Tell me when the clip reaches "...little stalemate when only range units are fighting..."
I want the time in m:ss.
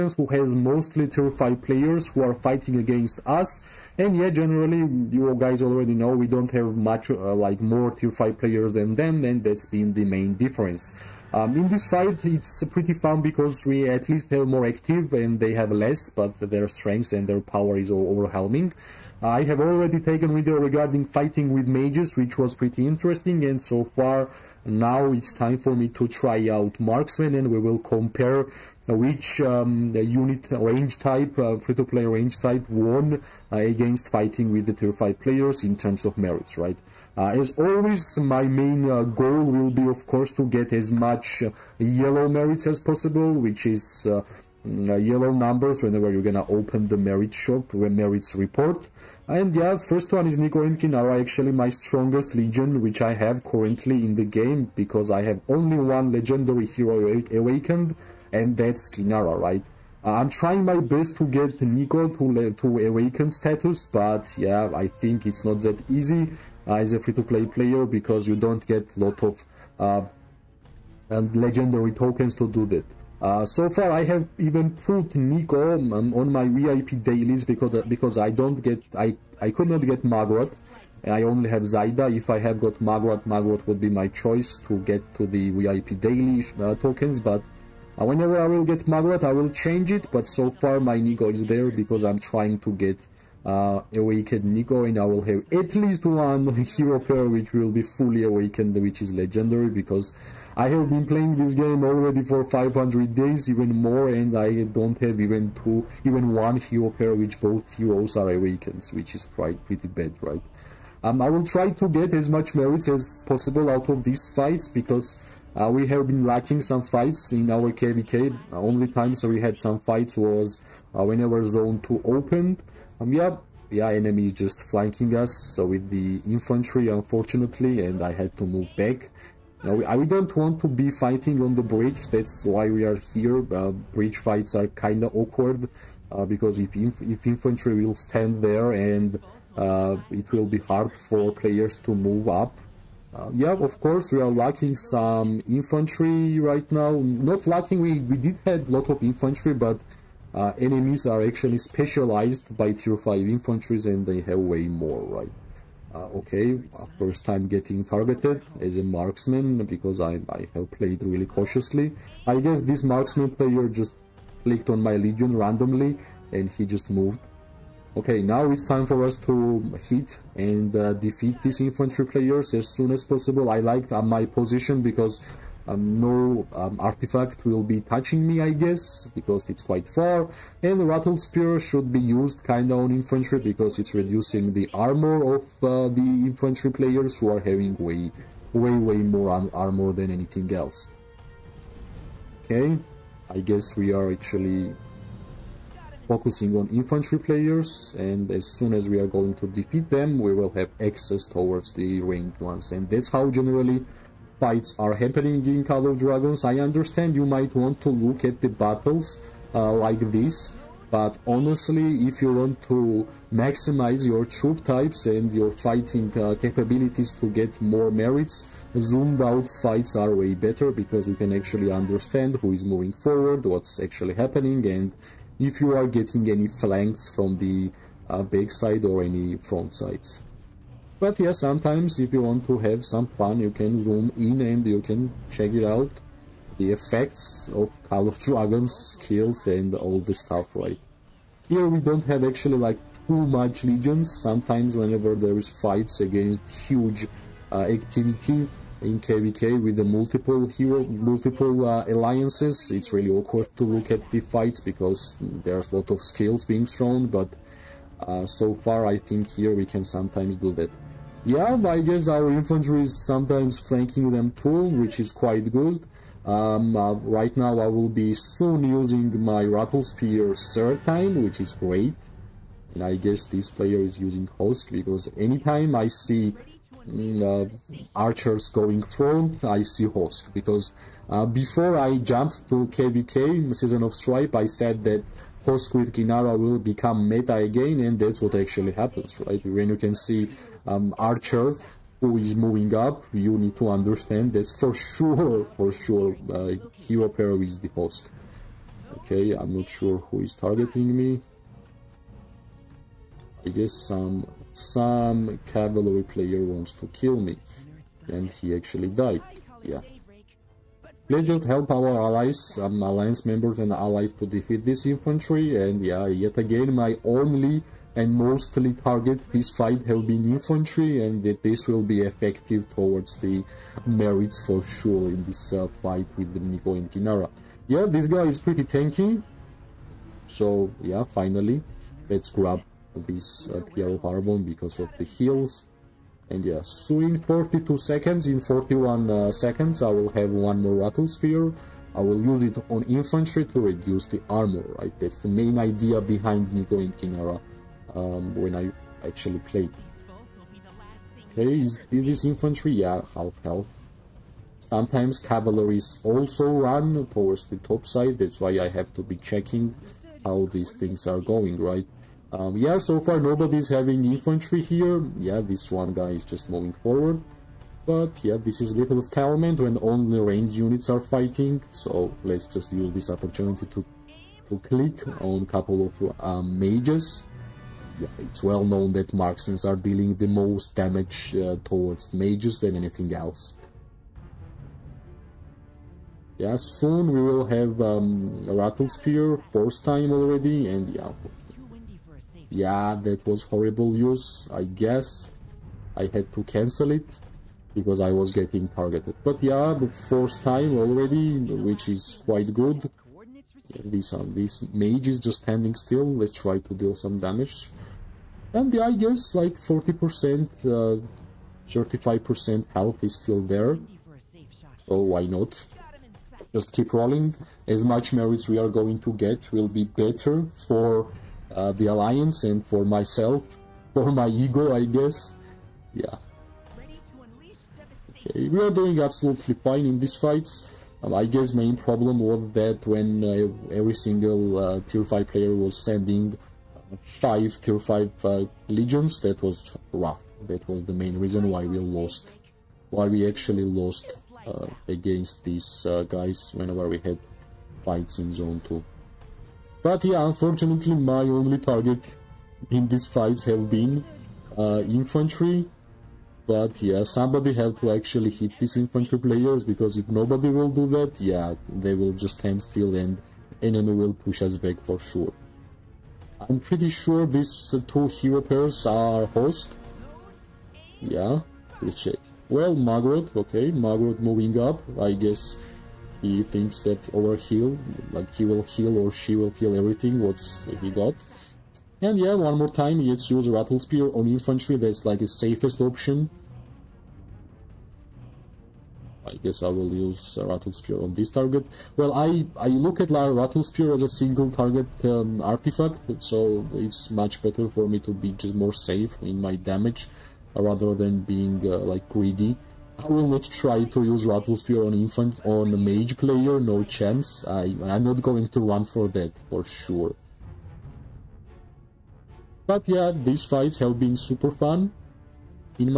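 6:08.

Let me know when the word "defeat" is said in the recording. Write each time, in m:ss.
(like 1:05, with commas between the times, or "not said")
2:50, 3:19, 5:14.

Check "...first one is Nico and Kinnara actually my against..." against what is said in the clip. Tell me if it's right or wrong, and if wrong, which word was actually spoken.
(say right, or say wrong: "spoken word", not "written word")
wrong: "strongest", not "against".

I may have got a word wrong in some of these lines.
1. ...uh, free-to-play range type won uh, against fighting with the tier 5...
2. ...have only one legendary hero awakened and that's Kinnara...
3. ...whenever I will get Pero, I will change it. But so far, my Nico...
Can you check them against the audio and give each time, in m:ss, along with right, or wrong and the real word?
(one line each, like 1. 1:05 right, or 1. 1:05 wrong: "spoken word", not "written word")
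1. 0:31 right
2. 0:55 right
3. 1:28 wrong: "Margaret", not "Pero".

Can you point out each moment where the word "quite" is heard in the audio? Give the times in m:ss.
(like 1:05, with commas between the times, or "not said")
1:49, 2:59, 4:25, 6:42.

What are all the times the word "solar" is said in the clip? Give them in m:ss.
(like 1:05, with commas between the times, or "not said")
not said.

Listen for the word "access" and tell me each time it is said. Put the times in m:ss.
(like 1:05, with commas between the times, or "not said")
3:20.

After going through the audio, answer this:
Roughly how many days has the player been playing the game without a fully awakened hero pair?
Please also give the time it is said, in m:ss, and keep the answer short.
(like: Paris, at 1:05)
500, at 1:42.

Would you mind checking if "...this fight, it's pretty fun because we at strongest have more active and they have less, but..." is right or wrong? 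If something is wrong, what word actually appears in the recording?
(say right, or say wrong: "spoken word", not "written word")
wrong: "least", not "strongest".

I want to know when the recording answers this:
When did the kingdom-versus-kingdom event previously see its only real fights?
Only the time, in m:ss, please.
2:01.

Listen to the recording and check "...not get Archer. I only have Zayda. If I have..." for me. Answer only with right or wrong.
wrong.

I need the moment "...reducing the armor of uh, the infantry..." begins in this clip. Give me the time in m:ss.
3:03.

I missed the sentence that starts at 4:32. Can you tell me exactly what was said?
And I guess this player is using Hosk, because anytime I see mm, uh, archers going front, I see Hosk.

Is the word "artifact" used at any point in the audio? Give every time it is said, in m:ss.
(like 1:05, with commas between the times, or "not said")
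2:56, 8:15.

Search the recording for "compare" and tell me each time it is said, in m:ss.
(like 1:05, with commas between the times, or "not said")
0:27.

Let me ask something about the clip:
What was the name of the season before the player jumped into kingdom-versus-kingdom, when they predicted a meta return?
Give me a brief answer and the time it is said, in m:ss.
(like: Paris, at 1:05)
Season of Stripe, at 4:43.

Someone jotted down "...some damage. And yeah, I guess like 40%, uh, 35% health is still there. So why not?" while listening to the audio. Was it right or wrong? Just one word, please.
right.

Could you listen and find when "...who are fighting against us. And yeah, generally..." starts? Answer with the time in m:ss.
0:02.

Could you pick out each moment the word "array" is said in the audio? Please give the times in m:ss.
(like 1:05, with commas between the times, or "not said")
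not said.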